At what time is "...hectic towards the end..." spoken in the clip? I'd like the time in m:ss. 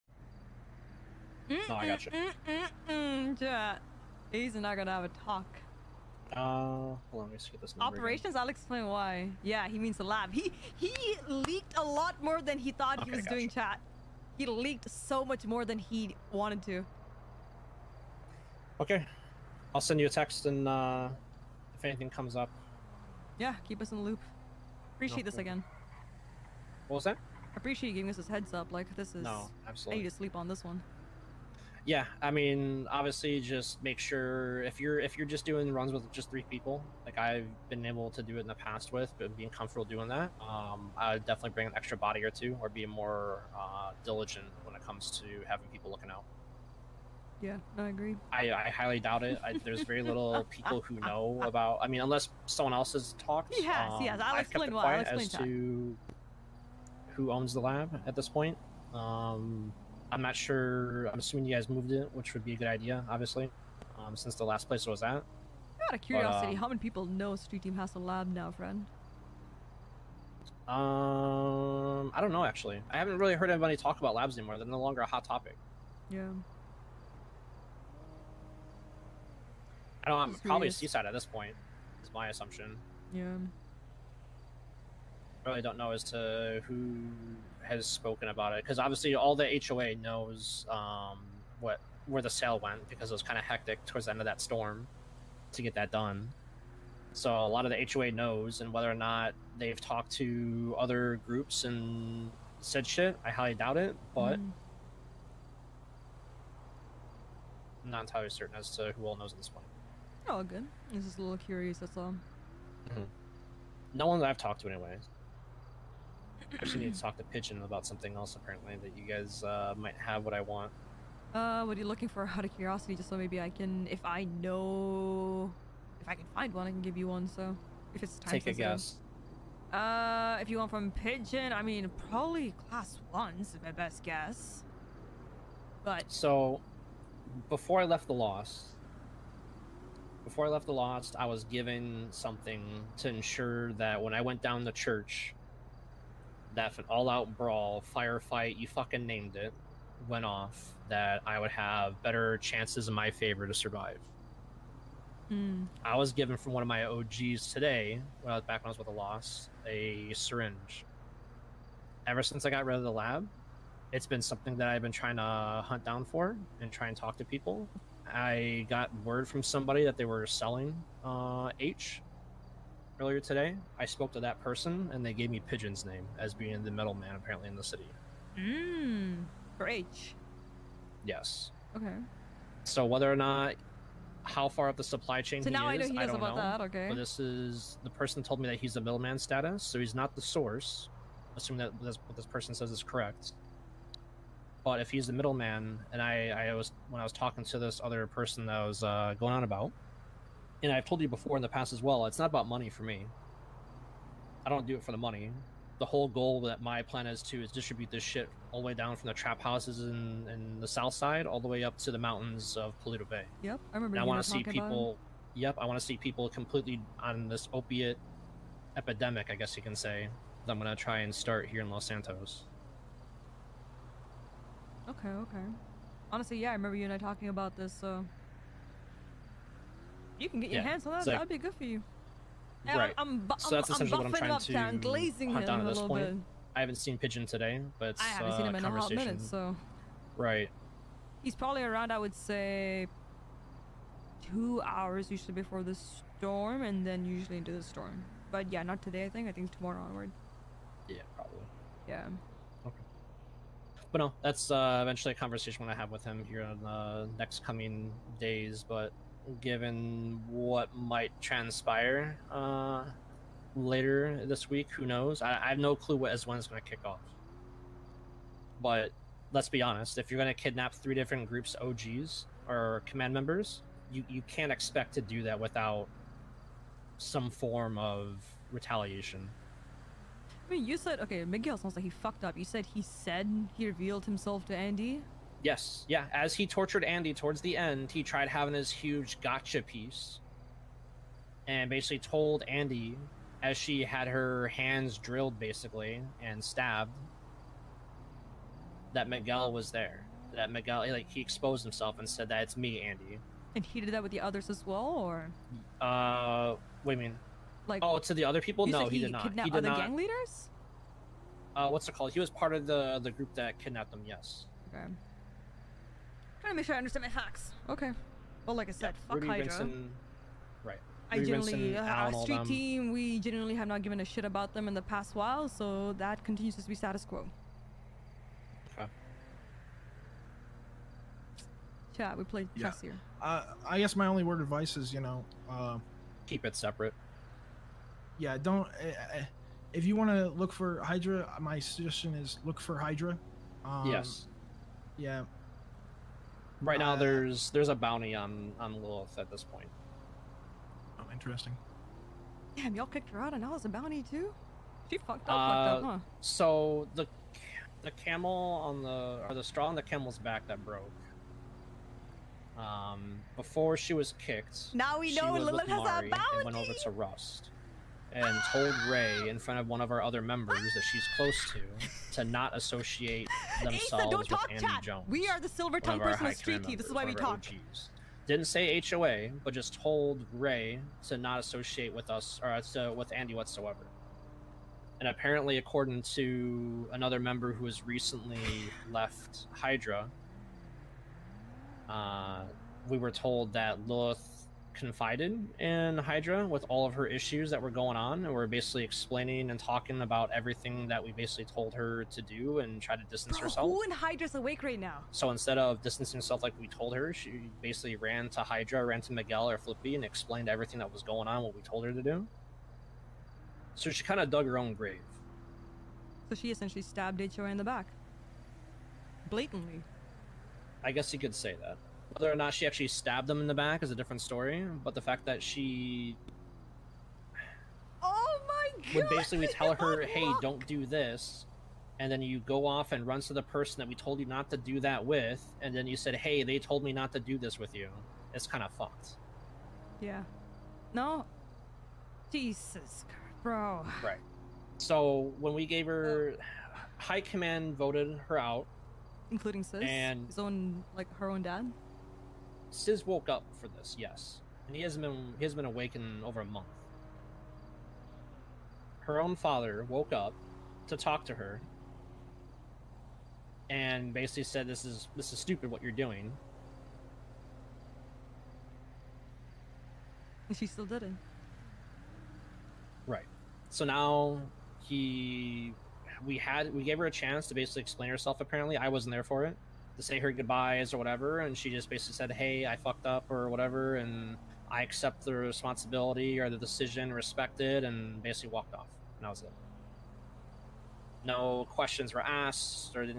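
1:33.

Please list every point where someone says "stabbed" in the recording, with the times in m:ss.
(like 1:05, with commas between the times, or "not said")
4:56, 6:56, 7:02.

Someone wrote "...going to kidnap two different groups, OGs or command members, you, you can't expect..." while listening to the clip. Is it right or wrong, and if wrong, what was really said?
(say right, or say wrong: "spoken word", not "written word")
wrong: "three", not "two".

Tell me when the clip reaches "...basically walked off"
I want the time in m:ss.
8:08.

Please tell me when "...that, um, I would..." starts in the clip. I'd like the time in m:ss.
0:40.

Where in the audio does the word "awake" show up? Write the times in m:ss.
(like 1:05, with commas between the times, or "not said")
6:44, 7:35.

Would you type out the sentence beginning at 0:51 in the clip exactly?
I mean, unless someone else has talked.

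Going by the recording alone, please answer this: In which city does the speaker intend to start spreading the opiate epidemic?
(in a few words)
Los Santos.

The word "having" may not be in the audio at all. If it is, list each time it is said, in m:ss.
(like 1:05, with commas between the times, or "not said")
0:45, 4:48.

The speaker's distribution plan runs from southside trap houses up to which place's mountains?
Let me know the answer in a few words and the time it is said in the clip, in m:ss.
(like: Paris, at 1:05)
Paleto Bay, at 3:32.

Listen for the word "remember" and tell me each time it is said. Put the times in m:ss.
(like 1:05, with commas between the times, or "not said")
3:33, 3:46.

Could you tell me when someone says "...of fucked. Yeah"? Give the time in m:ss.
7:18.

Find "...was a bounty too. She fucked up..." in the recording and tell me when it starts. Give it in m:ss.
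5:53.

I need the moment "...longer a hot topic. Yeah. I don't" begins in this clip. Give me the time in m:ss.
1:14.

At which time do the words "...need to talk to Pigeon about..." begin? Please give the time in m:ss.
1:56.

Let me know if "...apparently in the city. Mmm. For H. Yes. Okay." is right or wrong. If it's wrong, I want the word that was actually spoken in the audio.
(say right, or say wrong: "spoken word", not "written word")
right.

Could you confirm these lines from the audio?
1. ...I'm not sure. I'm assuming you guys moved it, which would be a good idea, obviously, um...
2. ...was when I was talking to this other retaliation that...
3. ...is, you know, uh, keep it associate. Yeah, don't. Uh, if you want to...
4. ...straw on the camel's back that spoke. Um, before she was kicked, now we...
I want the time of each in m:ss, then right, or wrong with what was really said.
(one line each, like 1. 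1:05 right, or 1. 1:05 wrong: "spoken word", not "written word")
1. 1:00 right
2. 3:16 wrong: "person", not "retaliation"
3. 5:34 wrong: "separate", not "associate"
4. 5:59 wrong: "broke", not "spoke".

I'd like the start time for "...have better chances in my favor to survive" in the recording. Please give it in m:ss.
2:31.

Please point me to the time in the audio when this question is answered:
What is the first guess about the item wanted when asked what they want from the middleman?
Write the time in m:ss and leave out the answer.
2:12.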